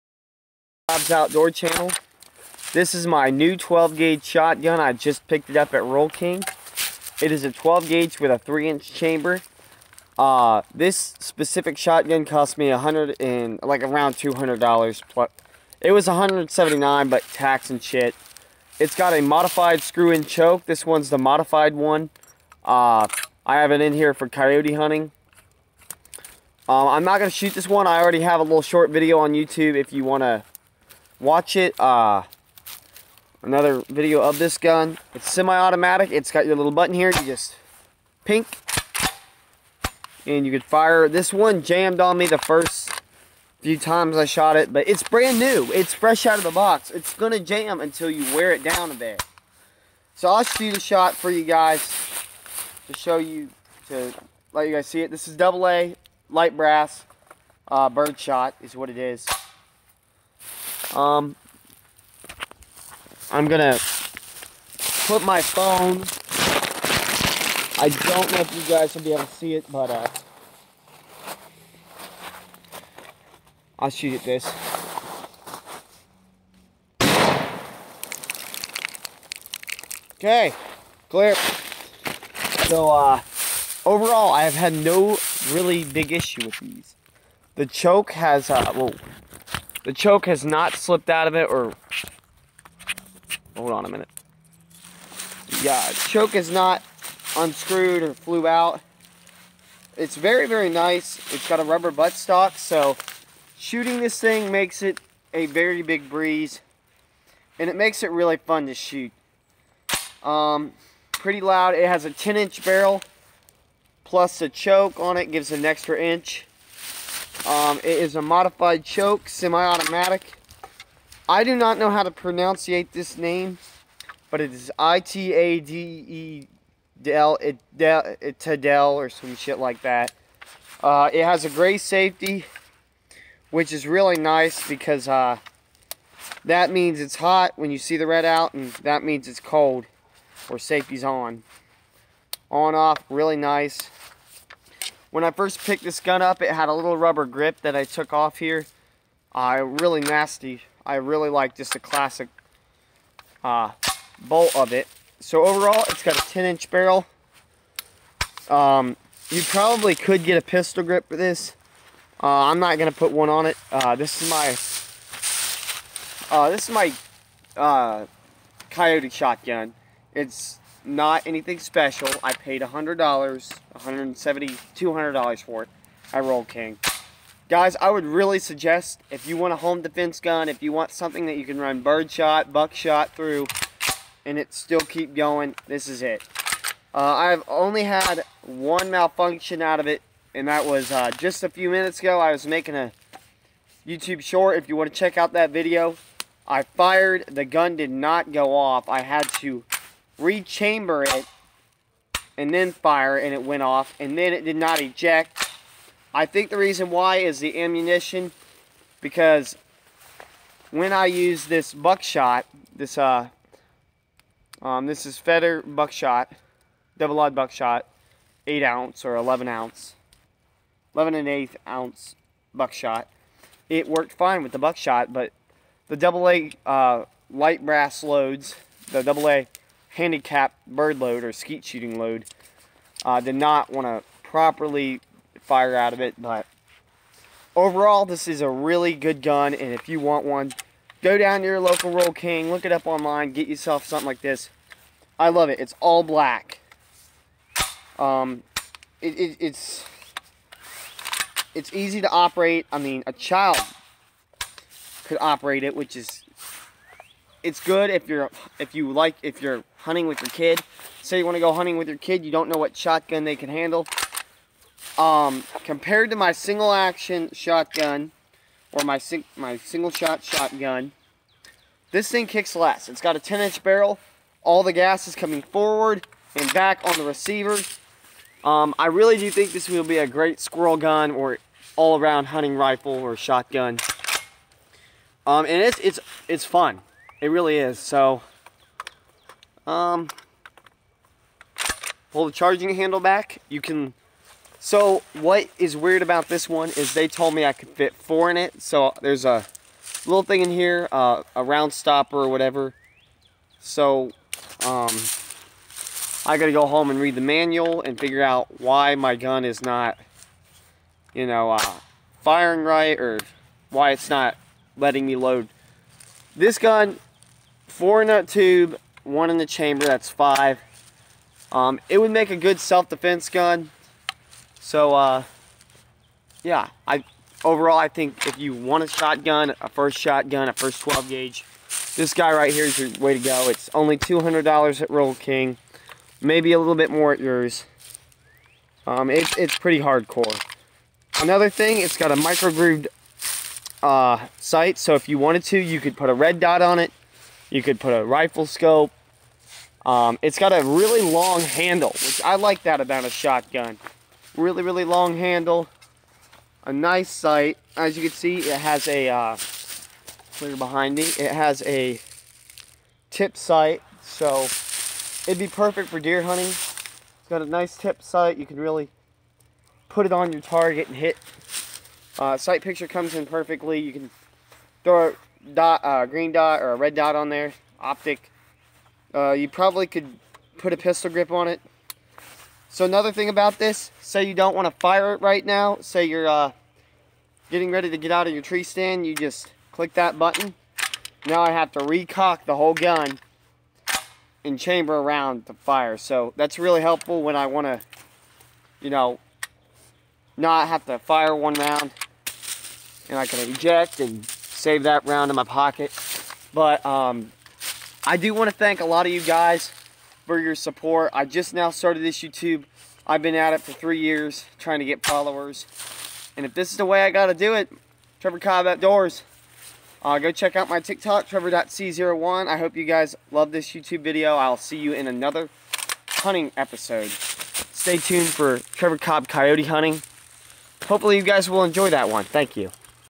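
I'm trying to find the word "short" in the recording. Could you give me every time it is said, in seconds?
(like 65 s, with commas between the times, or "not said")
28 s, 194 s.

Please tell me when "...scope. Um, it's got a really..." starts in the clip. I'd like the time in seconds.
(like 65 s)
348 s.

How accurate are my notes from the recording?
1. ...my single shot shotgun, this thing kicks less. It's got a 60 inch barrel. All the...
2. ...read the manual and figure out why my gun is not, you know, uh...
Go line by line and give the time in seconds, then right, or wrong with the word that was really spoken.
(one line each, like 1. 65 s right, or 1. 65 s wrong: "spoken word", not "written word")
1. 269 s wrong: "10", not "60"
2. 306 s right.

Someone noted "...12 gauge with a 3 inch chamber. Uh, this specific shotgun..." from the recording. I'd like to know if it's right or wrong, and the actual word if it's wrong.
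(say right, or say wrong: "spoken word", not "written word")
right.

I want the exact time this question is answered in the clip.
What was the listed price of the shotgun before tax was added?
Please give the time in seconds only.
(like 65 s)
16 s.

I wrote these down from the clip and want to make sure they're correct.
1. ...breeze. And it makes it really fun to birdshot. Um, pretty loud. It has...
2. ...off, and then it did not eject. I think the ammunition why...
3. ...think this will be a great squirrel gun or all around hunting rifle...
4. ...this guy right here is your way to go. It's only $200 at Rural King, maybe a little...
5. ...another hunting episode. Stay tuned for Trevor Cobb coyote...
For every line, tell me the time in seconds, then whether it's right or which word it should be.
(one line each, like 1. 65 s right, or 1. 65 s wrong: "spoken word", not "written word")
1. 106 s wrong: "shoot", not "birdshot"
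2. 203 s wrong: "reason", not "ammunition"
3. 279 s right
4. 331 s right
5. 425 s right.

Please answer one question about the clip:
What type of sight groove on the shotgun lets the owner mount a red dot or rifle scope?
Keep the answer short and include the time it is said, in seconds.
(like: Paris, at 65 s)
micro grooved, at 342 s.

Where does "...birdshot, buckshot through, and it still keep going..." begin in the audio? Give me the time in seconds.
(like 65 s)
181 s.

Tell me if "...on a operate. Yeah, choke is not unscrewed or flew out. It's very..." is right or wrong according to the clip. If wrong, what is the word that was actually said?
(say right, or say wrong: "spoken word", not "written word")
wrong: "minute", not "operate".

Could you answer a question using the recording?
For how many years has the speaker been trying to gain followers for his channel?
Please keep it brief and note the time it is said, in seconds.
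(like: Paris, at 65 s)
3, at 413 s.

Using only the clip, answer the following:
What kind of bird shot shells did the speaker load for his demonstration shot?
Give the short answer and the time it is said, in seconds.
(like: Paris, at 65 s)
double A light brass, at 55 s.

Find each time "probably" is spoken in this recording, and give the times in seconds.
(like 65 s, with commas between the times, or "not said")
159 s, 379 s.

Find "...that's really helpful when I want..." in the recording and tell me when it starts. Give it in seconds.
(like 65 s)
396 s.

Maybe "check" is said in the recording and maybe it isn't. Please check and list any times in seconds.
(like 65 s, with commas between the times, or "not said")
194 s, 420 s.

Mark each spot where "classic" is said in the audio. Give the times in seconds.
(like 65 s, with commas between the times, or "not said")
151 s.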